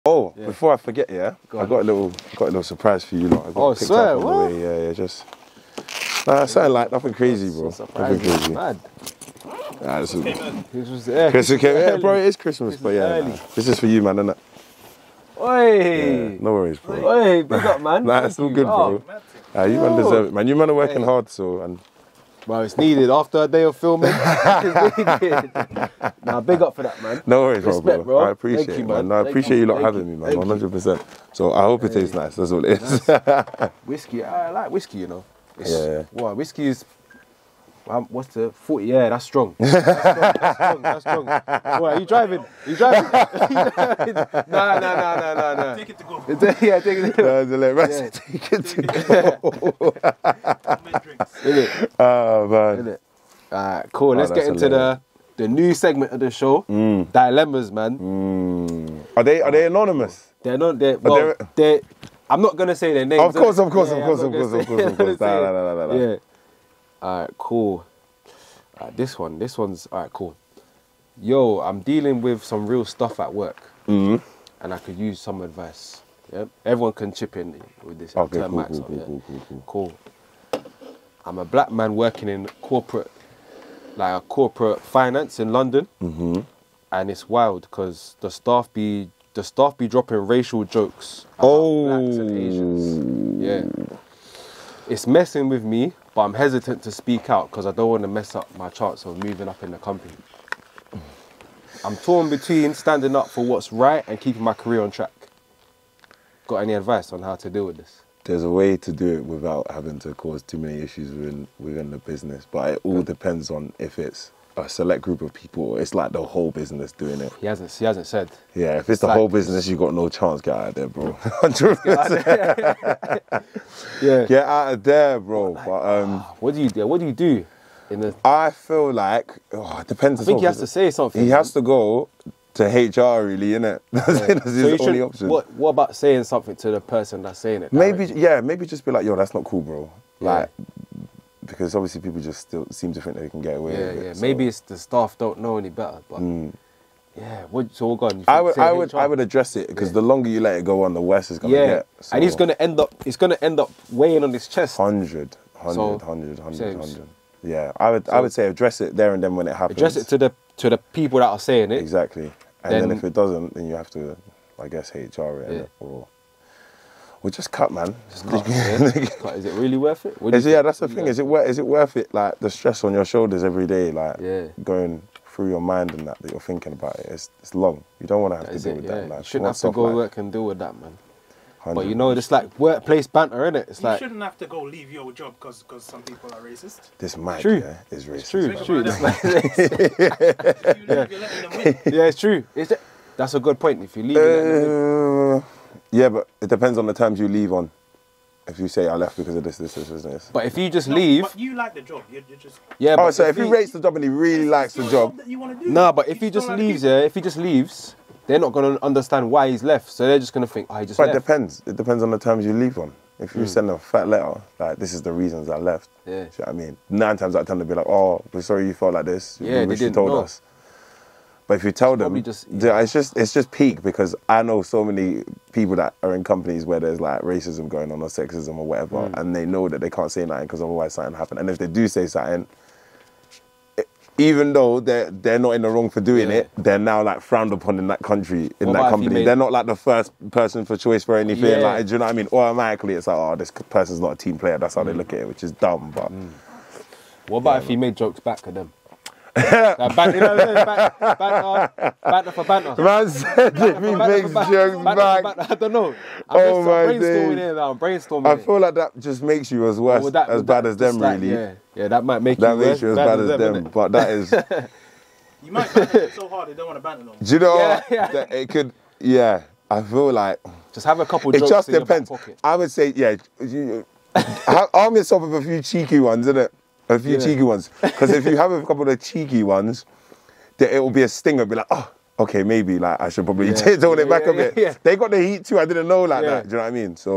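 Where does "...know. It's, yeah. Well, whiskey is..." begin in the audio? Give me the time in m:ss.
0:35.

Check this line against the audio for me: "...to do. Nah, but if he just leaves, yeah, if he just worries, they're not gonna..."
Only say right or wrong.
wrong.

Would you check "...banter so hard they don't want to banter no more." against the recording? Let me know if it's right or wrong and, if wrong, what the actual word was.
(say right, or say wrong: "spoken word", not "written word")
right.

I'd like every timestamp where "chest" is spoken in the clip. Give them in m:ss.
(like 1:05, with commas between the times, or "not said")
2:34.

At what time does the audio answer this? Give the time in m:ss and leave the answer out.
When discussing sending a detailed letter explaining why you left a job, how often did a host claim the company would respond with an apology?
3:36.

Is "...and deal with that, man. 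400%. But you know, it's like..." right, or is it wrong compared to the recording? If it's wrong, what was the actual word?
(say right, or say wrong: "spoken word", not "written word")
wrong: "100", not "400".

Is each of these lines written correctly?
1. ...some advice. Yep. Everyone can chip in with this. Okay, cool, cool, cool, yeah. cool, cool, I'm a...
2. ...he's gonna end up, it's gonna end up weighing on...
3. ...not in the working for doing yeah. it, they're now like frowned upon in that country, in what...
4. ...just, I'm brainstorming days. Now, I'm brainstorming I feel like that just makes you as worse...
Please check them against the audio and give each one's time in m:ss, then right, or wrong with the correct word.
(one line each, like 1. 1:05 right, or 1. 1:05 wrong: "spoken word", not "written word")
1. 1:15 right
2. 2:32 right
3. 3:55 wrong: "wrong", not "working"
4. 4:16 right.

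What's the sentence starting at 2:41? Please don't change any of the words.
Exactly, and then, then if it doesn't, then you have to, I guess, HR it yeah.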